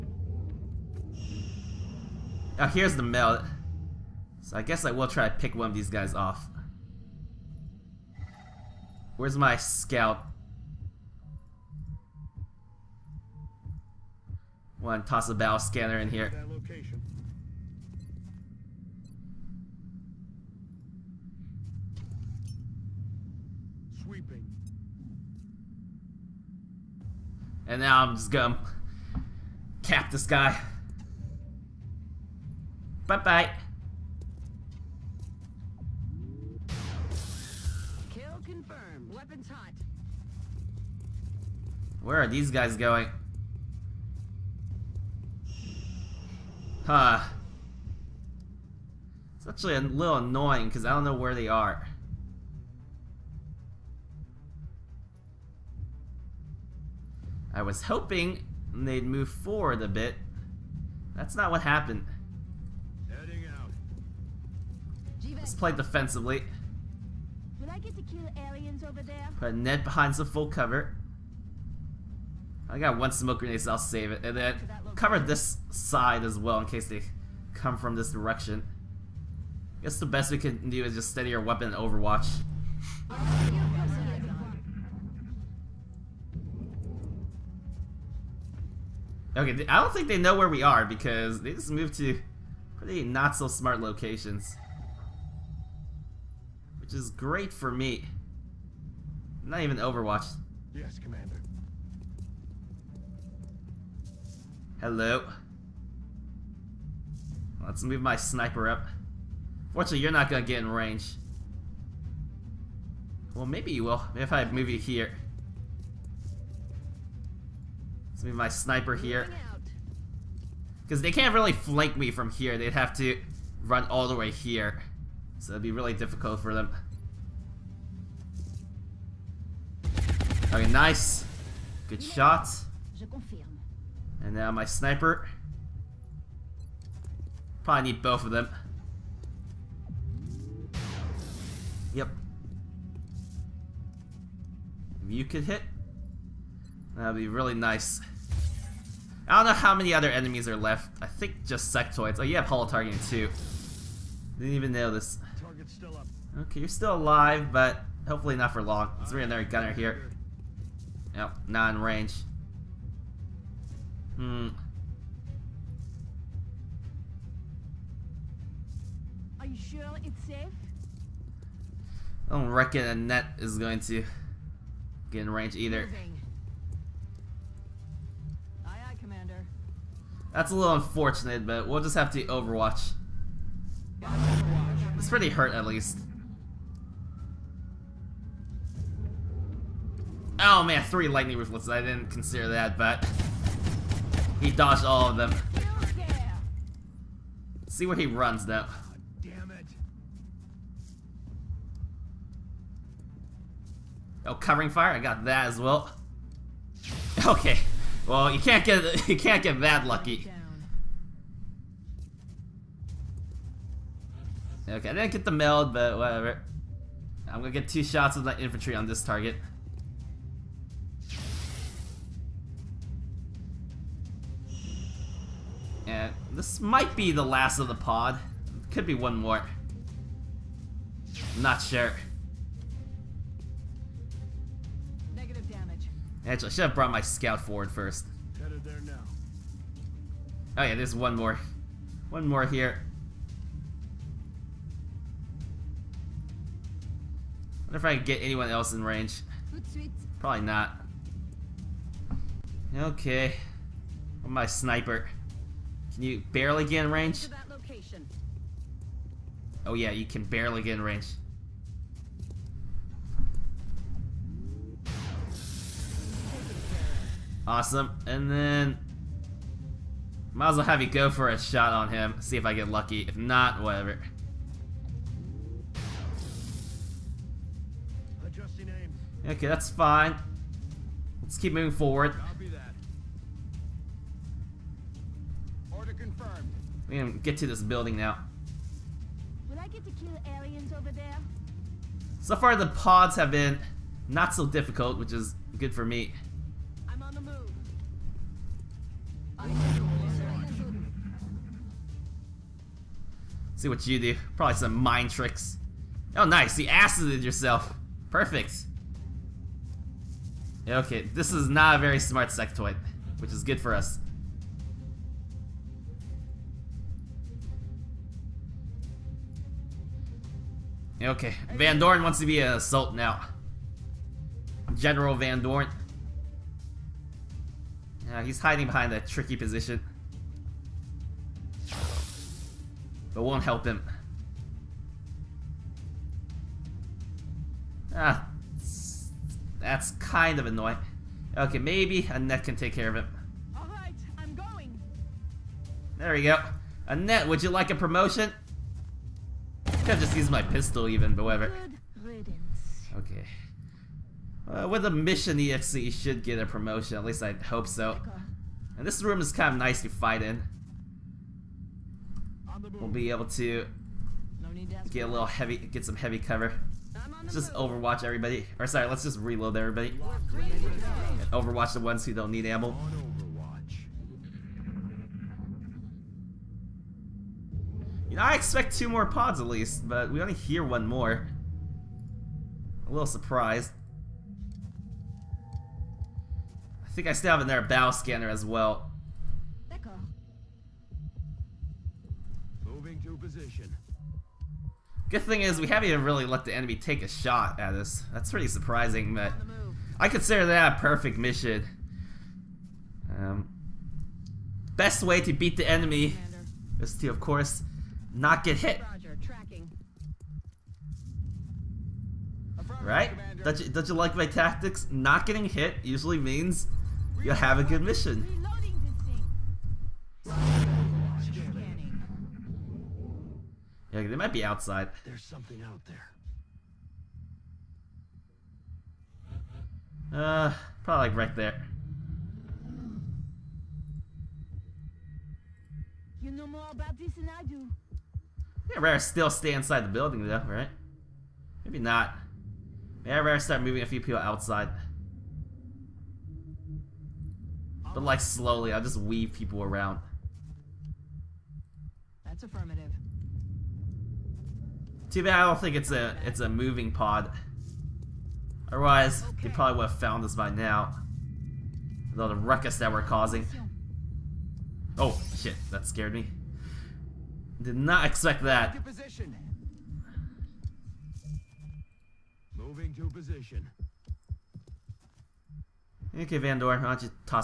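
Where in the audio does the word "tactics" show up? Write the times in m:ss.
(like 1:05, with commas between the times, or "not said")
6:54.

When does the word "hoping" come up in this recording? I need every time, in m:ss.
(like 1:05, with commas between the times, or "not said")
0:57.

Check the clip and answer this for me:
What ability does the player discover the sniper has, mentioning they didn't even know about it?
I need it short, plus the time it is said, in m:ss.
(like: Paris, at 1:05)
Holo targeting, at 2:32.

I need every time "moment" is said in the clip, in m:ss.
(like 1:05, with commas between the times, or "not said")
not said.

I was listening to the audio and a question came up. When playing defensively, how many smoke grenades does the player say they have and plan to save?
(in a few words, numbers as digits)
1.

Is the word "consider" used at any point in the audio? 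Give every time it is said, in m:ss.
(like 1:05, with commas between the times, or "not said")
3:12, 6:40.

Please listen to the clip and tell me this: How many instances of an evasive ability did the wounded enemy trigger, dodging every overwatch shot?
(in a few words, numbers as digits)
3.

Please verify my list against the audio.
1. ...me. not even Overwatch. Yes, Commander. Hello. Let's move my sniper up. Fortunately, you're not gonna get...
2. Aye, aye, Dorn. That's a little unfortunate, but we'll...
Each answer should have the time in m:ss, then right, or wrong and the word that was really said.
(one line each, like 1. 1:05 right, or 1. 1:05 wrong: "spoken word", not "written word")
1. 1:37 right
2. 2:58 wrong: "Commander", not "Dorn".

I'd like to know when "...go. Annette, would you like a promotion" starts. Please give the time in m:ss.
5:46.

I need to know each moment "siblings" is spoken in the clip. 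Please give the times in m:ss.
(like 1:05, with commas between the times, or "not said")
not said.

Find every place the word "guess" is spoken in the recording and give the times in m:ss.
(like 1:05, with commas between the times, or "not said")
0:04, 1:19.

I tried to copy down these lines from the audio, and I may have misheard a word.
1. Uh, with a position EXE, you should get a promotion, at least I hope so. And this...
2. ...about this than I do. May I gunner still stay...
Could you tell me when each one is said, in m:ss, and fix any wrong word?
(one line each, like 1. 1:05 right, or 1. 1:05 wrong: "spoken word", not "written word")
1. 5:54 wrong: "mission", not "position"
2. 7:16 wrong: "rather", not "gunner".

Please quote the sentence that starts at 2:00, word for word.
Because they can't really flank me from here.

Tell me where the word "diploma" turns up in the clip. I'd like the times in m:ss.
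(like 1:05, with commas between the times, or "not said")
not said.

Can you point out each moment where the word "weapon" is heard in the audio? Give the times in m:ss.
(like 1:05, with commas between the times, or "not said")
1:21.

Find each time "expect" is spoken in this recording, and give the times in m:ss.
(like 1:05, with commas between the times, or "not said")
6:18, 7:48.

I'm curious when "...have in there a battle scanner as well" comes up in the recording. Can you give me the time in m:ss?
6:27.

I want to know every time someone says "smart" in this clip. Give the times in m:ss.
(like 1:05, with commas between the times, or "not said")
1:33, 5:11.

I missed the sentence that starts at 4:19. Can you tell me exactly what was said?
Oh yeah, you can barely get in range.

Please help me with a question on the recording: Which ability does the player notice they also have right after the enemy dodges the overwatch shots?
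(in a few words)
Covering fire.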